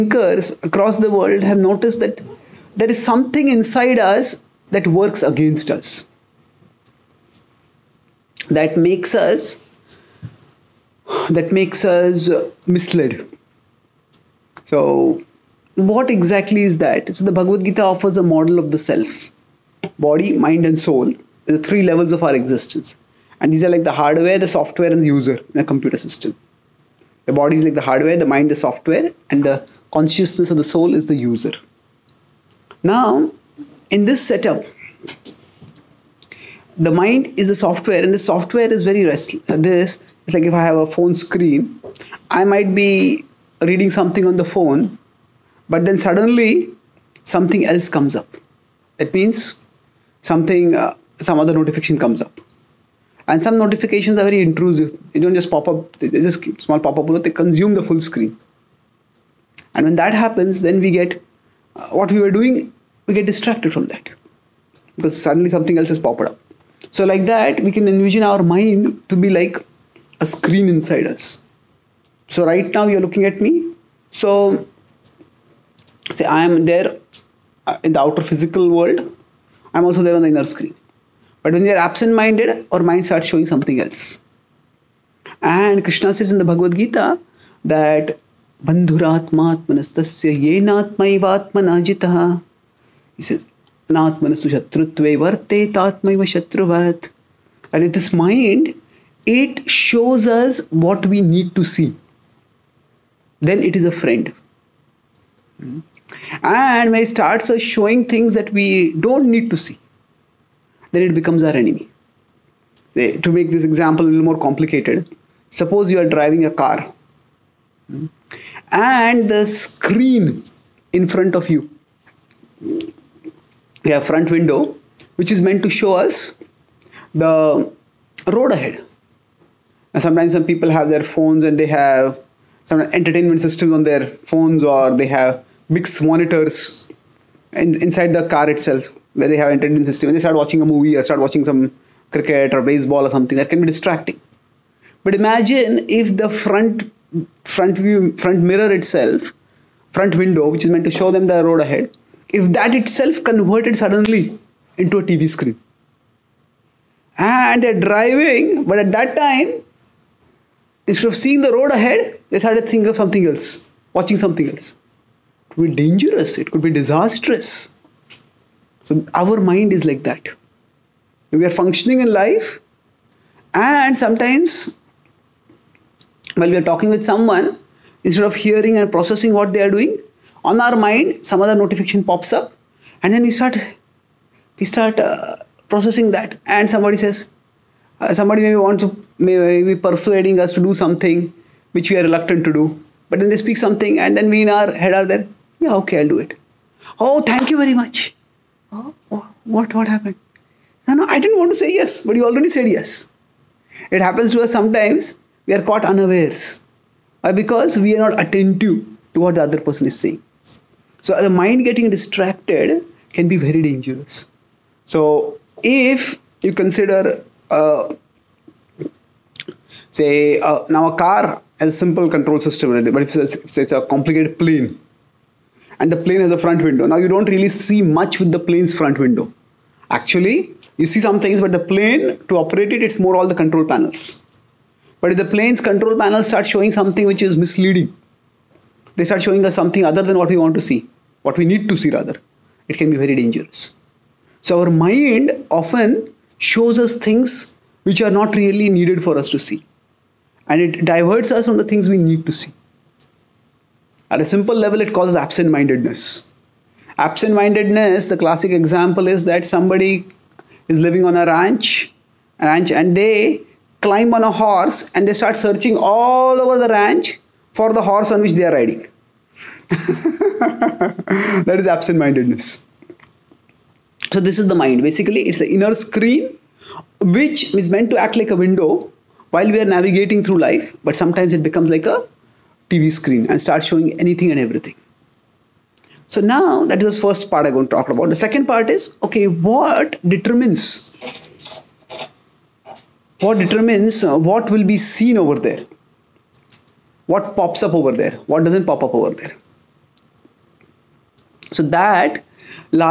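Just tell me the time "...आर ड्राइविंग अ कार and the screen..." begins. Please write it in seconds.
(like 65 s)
115 s.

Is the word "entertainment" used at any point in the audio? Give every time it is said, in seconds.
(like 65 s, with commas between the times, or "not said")
132 s, 139 s.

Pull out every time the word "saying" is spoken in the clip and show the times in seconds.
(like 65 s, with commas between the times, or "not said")
209 s.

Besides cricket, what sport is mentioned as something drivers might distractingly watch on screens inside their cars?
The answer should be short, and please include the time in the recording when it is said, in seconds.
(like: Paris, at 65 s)
baseball, at 142 s.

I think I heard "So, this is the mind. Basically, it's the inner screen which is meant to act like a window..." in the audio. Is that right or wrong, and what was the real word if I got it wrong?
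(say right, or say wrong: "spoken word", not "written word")
right.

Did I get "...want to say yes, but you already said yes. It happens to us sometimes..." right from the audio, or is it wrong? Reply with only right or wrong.
right.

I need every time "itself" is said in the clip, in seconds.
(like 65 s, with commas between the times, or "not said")
138 s, 148 s, 152 s.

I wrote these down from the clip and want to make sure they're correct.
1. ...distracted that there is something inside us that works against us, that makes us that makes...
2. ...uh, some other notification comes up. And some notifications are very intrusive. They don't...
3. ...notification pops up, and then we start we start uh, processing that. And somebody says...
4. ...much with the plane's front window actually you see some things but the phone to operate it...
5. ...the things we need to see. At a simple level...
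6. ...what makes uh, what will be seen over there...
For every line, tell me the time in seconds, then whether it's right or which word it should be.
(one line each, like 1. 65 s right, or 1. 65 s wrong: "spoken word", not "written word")
1. 1 s wrong: "noticed", not "distracted"
2. 50 s right
3. 181 s right
4. 227 s wrong: "plane", not "phone"
5. 251 s right
6. 293 s wrong: "determines", not "makes".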